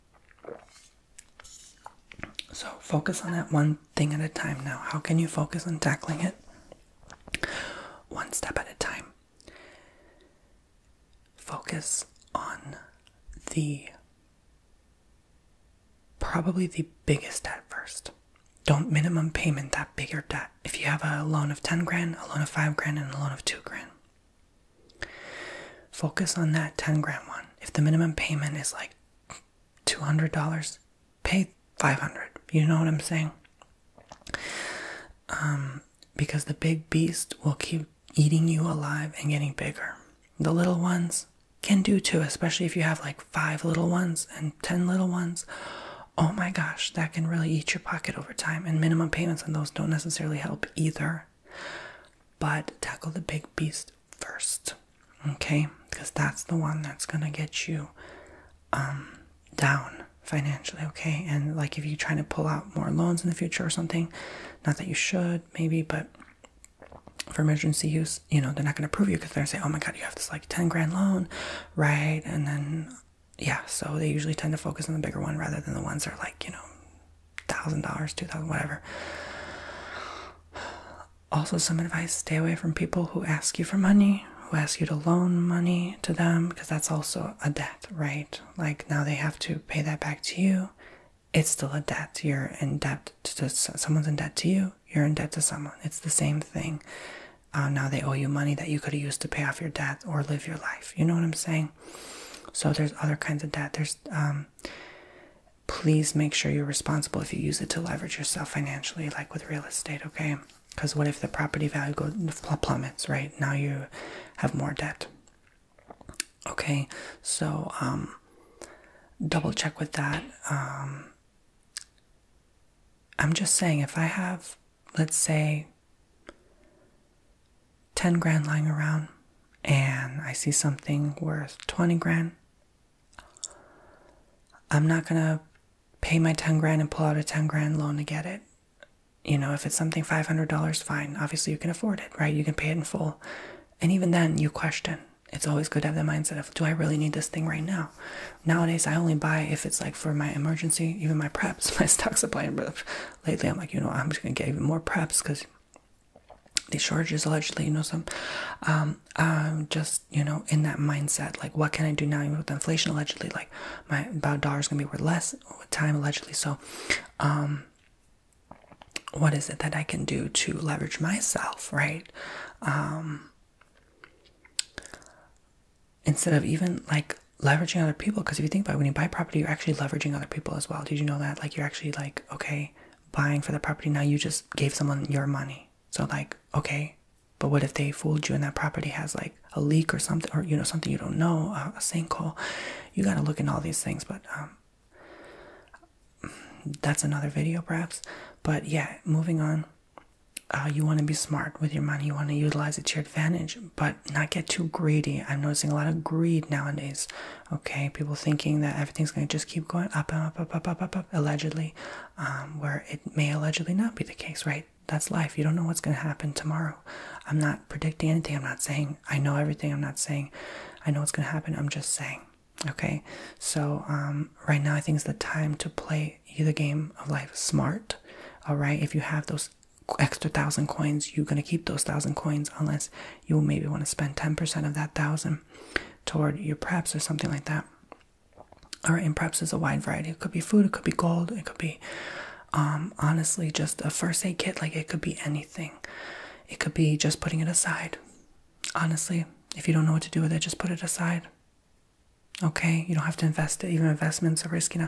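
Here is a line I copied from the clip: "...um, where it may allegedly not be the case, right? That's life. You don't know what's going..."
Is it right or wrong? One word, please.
right.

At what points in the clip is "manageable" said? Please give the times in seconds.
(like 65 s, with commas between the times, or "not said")
not said.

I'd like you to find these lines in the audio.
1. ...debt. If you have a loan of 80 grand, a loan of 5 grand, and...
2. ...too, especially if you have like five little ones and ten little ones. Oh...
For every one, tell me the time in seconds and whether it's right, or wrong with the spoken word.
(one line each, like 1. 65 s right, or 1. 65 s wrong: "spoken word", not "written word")
1. 20 s wrong: "10", not "80"
2. 41 s right.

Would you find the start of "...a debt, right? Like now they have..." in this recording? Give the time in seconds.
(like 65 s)
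87 s.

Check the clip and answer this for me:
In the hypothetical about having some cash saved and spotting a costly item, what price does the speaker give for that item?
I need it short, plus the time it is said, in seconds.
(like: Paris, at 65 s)
$20,000, at 131 s.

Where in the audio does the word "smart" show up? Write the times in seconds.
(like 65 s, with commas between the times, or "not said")
201 s, 227 s.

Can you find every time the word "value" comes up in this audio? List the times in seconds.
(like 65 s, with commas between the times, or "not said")
111 s.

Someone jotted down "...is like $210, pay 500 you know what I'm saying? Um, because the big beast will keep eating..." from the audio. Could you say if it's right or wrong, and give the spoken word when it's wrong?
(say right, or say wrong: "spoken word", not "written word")
wrong: "200", not "210".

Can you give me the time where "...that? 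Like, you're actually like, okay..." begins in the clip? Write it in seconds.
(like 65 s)
181 s.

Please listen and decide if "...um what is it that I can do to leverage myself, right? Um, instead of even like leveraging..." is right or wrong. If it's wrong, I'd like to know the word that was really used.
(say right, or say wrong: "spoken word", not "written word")
right.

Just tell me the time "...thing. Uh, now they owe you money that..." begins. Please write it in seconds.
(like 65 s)
96 s.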